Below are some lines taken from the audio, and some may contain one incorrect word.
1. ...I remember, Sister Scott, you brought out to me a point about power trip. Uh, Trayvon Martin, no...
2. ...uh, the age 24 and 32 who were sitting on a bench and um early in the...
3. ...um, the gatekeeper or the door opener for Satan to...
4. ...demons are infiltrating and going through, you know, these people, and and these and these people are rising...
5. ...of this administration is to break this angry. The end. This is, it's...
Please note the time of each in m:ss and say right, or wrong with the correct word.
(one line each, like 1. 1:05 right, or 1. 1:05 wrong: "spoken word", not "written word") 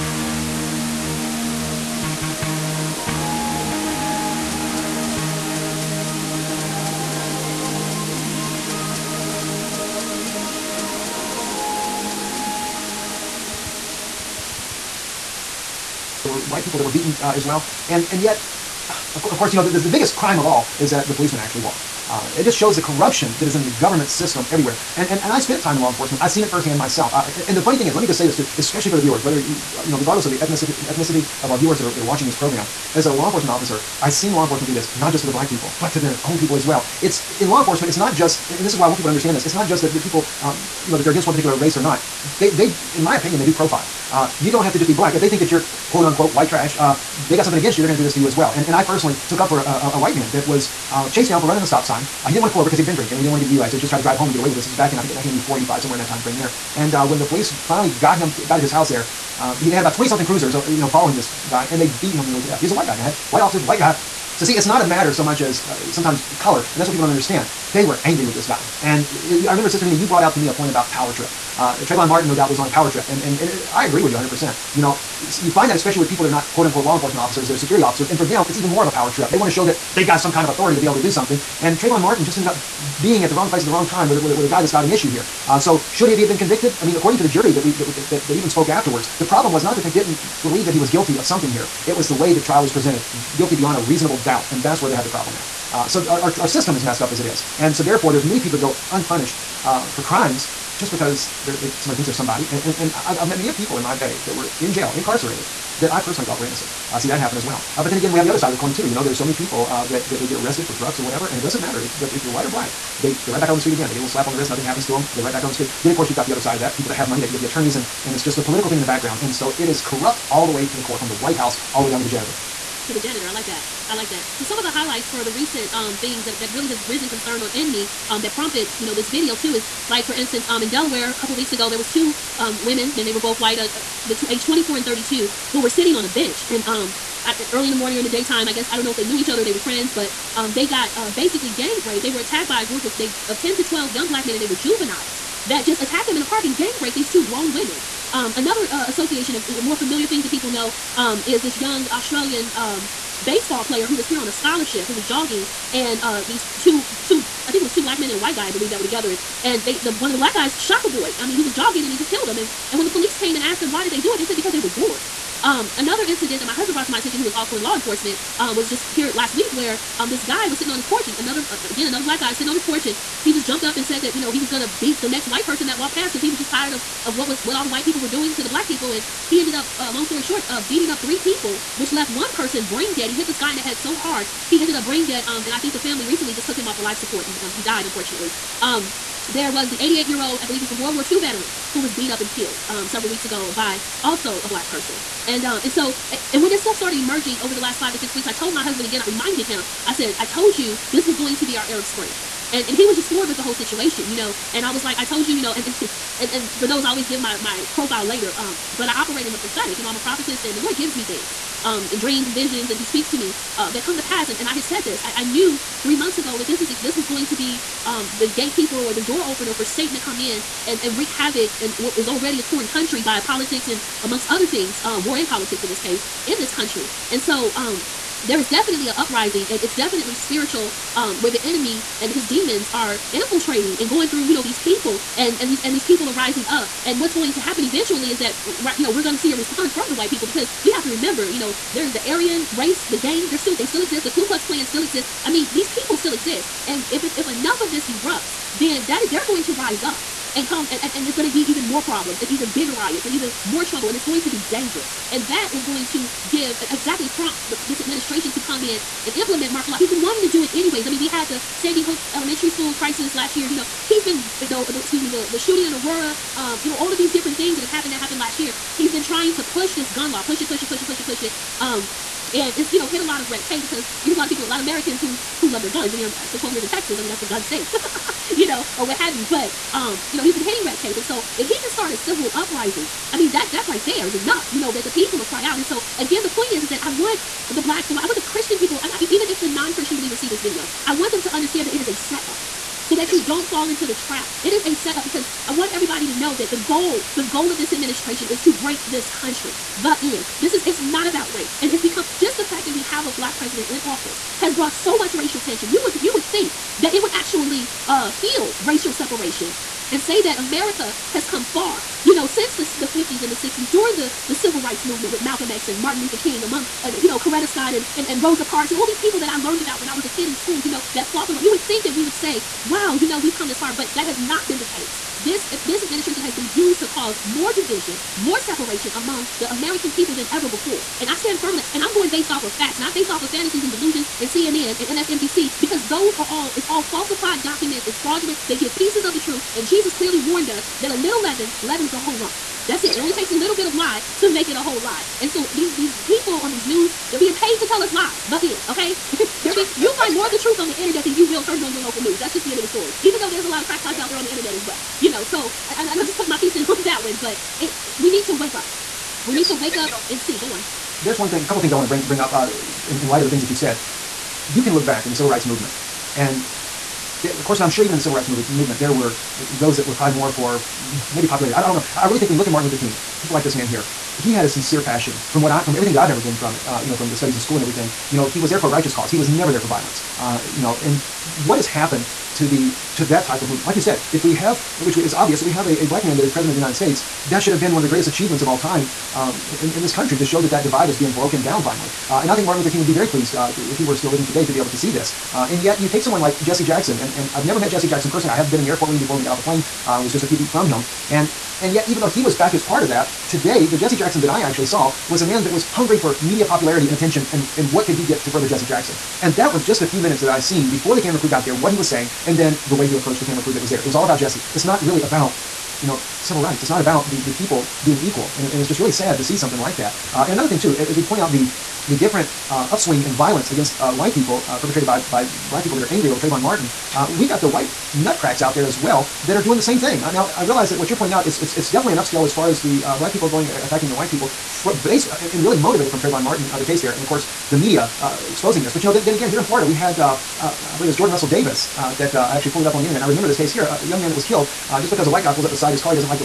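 1. 1:09 wrong: "Mena", not "Scott"
2. 2:13 right
3. 3:37 right
4. 3:52 right
5. 4:57 wrong: "country", not "angry".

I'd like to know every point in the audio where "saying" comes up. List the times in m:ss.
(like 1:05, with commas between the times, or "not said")
6:51.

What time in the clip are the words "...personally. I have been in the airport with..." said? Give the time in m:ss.
6:38.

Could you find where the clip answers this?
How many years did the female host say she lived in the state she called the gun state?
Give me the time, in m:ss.
4:36.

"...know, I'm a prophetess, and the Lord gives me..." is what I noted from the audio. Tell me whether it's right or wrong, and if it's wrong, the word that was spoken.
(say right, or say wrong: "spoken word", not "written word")
right.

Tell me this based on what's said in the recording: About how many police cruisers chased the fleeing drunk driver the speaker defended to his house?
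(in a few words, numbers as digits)
20 something.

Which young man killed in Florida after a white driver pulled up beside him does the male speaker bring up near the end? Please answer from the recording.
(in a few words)
Jordan Russell Davis.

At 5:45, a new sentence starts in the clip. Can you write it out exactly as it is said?
And so these these people on these news, they're being paid to tell us lies.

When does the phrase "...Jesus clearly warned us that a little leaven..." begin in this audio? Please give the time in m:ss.
5:39.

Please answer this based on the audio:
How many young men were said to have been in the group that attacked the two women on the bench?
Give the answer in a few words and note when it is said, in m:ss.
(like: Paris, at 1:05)
10 to 12, at 2:23.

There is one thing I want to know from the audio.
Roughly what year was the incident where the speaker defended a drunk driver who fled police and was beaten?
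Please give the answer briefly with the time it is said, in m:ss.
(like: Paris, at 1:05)
1984, at 0:55.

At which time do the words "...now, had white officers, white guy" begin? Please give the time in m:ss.
1:02.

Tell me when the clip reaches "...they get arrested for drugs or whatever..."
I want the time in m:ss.
1:50.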